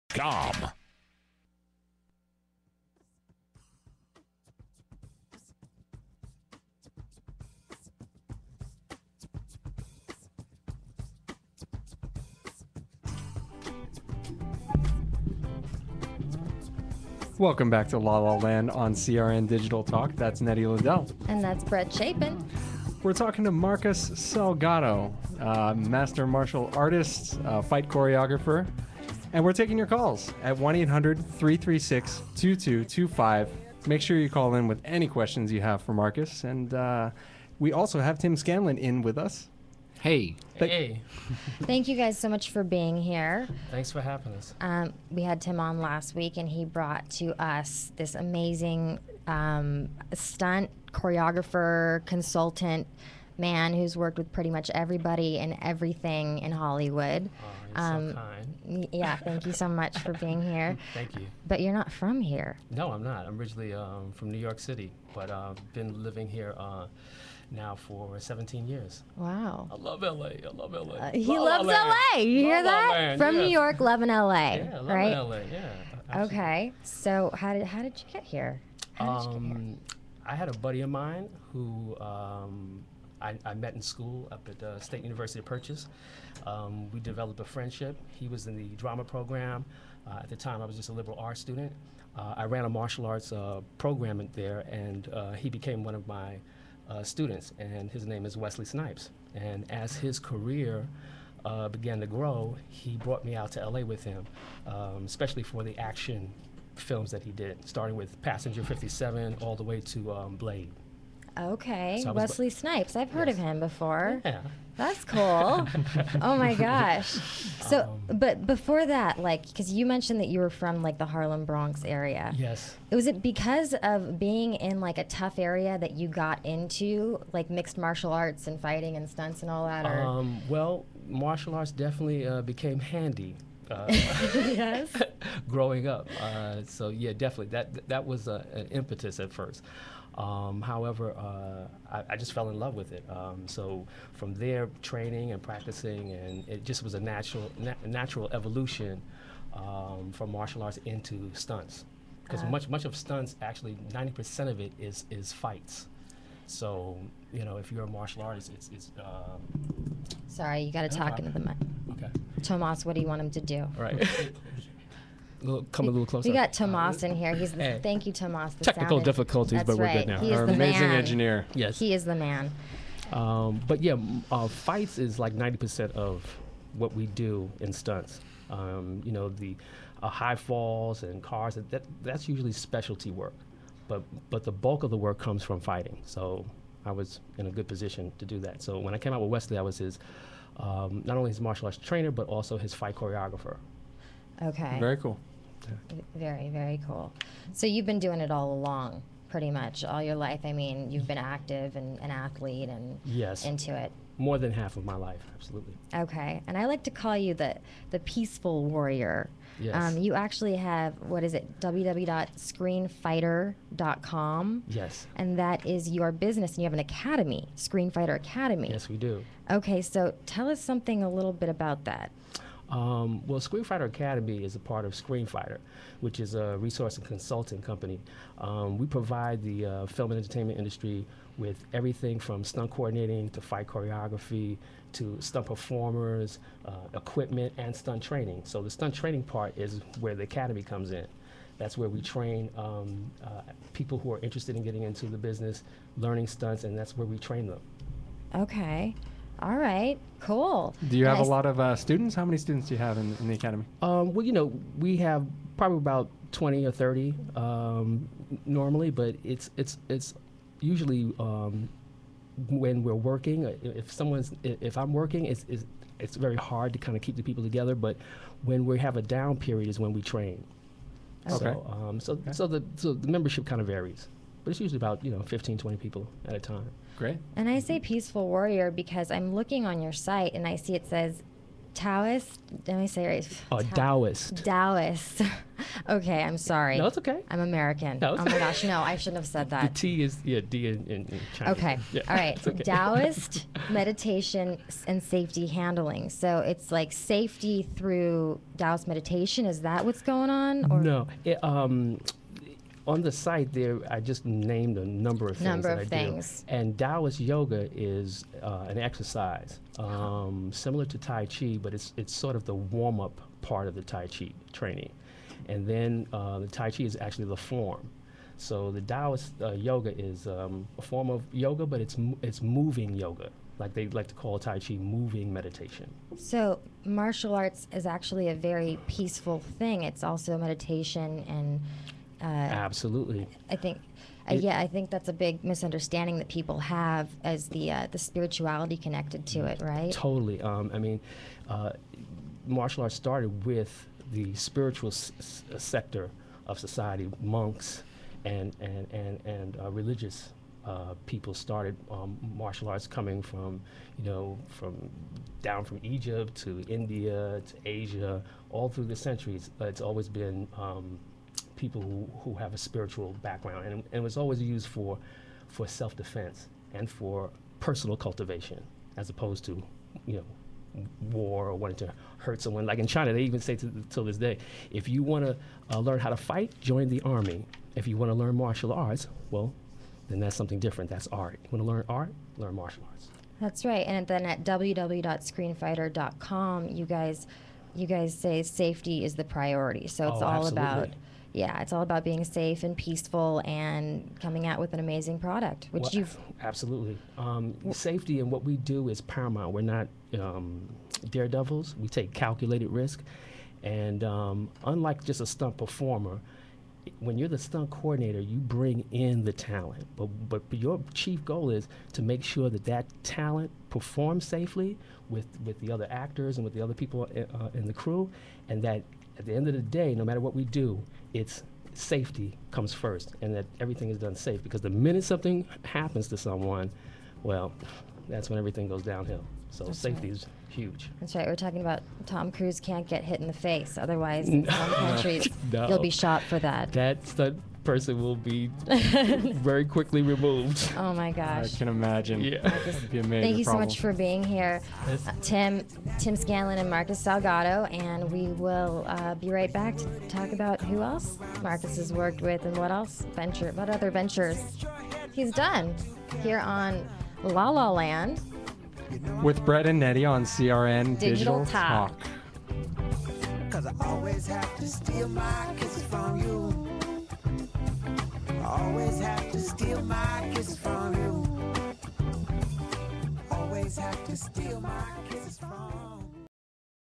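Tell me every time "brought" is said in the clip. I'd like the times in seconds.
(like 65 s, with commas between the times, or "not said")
46 s, 102 s.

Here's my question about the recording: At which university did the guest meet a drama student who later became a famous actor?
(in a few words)
State University of Purchase.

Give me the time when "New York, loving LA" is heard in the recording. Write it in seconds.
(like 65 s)
73 s.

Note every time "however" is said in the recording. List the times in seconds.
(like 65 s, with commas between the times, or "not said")
140 s.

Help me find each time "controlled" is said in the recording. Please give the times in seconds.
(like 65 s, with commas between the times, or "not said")
not said.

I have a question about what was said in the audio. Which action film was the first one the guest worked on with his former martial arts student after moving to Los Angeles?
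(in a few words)
Passenger 57.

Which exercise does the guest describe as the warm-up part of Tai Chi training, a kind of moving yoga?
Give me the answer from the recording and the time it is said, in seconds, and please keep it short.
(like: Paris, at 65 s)
Taoist yoga, at 306 s.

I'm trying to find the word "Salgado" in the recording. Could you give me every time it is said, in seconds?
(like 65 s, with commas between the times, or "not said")
24 s, 447 s.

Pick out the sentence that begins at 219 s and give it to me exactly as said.
Okay, so tell us something a little bit about that.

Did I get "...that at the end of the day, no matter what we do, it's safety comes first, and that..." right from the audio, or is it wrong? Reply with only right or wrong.
right.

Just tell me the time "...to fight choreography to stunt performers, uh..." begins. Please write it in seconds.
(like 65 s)
233 s.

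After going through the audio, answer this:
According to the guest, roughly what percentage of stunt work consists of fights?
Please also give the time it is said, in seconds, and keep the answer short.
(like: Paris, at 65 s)
90%, at 153 s.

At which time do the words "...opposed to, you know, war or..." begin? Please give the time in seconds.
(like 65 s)
369 s.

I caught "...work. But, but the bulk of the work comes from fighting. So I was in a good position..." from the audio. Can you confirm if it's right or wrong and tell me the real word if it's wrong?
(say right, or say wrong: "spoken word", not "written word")
right.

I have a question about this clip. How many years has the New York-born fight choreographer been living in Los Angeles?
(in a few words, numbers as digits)
17.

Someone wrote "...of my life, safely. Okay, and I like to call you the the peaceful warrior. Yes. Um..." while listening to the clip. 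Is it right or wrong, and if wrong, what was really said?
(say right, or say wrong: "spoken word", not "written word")
wrong: "absolutely", not "safely".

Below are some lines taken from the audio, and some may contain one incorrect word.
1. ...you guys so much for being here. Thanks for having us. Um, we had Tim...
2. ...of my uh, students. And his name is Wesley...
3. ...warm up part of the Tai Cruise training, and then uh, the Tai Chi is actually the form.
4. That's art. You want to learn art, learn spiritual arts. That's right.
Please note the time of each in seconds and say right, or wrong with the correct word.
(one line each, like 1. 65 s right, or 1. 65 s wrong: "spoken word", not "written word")
1. 41 s right
2. 95 s right
3. 312 s wrong: "Chi", not "Cruise"
4. 380 s wrong: "martial", not "spiritual".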